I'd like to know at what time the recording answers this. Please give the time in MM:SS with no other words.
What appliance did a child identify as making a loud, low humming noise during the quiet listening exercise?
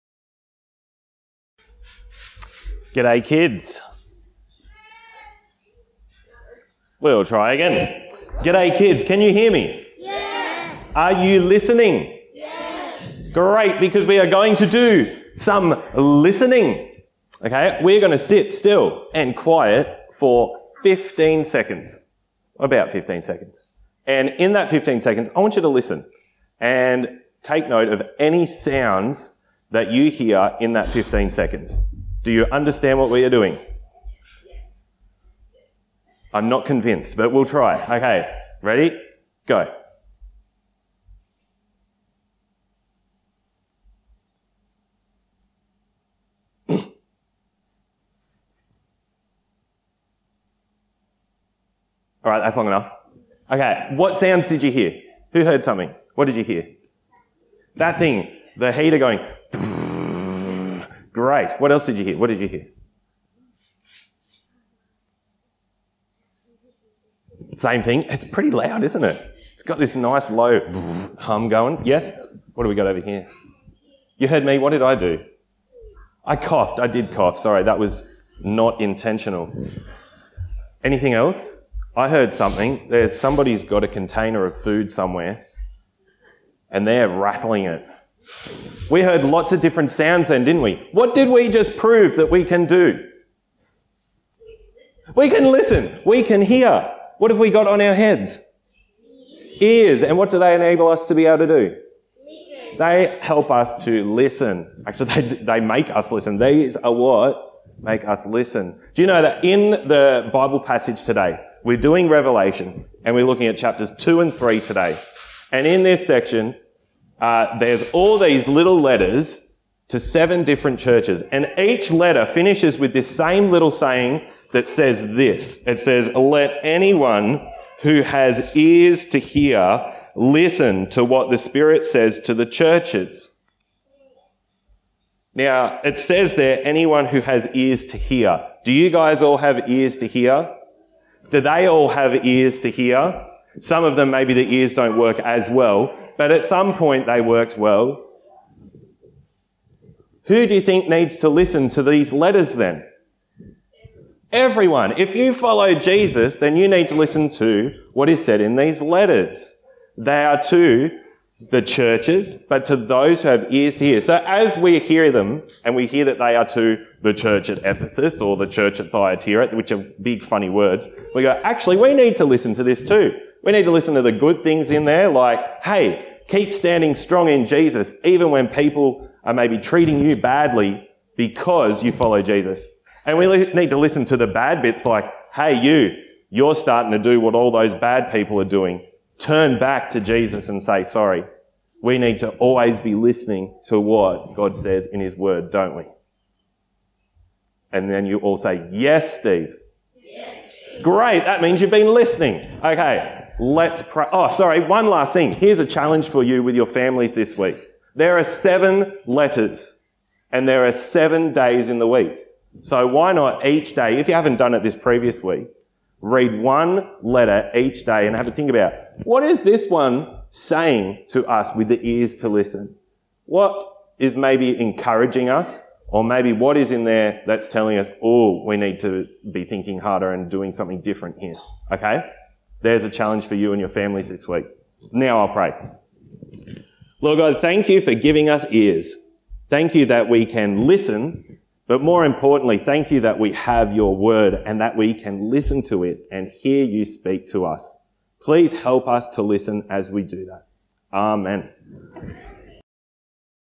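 00:58.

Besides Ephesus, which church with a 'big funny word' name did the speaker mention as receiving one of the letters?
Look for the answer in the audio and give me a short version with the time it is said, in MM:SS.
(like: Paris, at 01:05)
Thyatira, at 02:48.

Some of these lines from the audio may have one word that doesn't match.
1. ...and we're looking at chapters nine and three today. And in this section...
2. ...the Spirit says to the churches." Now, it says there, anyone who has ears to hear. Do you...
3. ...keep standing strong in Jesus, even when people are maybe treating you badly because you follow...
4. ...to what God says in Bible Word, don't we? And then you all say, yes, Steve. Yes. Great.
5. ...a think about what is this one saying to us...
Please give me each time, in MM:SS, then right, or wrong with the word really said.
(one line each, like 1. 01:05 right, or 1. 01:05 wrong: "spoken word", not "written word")
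1. 01:53 wrong: "two", not "nine"
2. 02:11 right
3. 02:56 right
4. 03:13 wrong: "His", not "Bible"
5. 03:38 right.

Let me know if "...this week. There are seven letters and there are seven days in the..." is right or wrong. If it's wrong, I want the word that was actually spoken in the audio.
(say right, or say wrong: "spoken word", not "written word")
right.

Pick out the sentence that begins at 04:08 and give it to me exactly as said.
Please help us to listen as we do that.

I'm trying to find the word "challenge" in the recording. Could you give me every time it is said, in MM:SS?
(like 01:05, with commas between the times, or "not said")
03:25, 03:52.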